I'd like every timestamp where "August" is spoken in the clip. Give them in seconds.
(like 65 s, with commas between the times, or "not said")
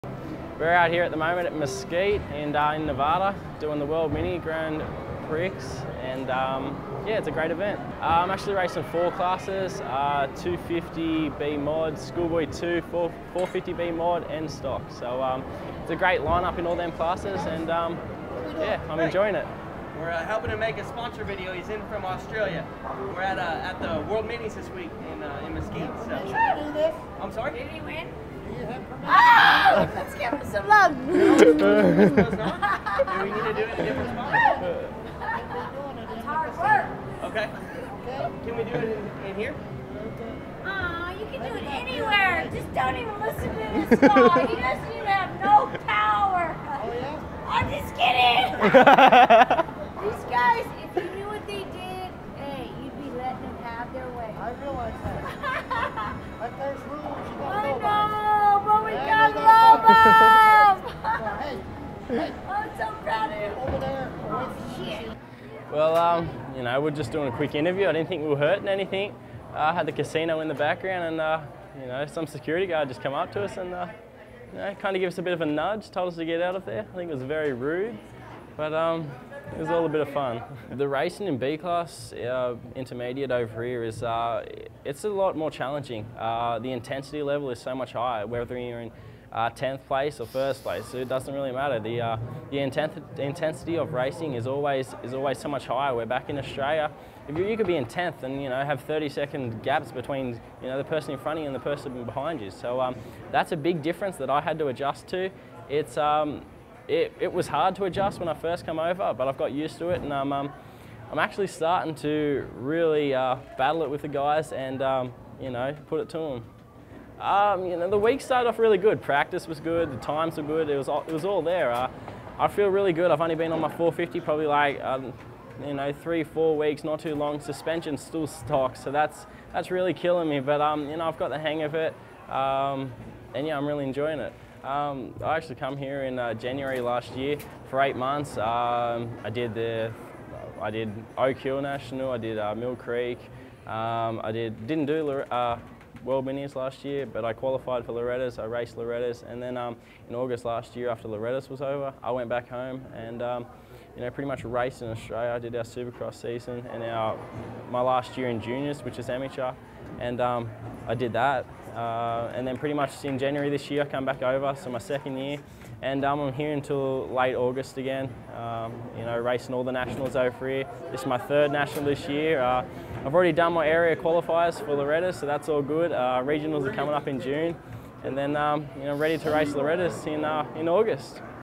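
150 s, 167 s, 180 s.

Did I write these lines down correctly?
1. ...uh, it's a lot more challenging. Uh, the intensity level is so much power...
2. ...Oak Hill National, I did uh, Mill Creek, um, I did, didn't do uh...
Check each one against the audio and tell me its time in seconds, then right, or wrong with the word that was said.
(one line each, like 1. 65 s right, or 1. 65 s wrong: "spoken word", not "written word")
1. 84 s wrong: "higher", not "power"
2. 141 s right.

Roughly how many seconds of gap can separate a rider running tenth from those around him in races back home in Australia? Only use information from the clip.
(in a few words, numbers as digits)
30 seconds.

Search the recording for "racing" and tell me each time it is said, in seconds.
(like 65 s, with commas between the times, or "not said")
8 s, 80 s, 93 s, 169 s.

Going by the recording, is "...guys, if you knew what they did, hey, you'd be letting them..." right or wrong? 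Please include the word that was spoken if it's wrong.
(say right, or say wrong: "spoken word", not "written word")
right.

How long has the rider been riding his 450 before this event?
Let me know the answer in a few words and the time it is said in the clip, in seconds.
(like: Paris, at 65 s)
three, four weeks, at 125 s.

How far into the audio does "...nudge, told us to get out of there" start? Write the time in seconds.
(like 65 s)
75 s.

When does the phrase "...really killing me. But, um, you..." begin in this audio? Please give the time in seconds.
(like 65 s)
129 s.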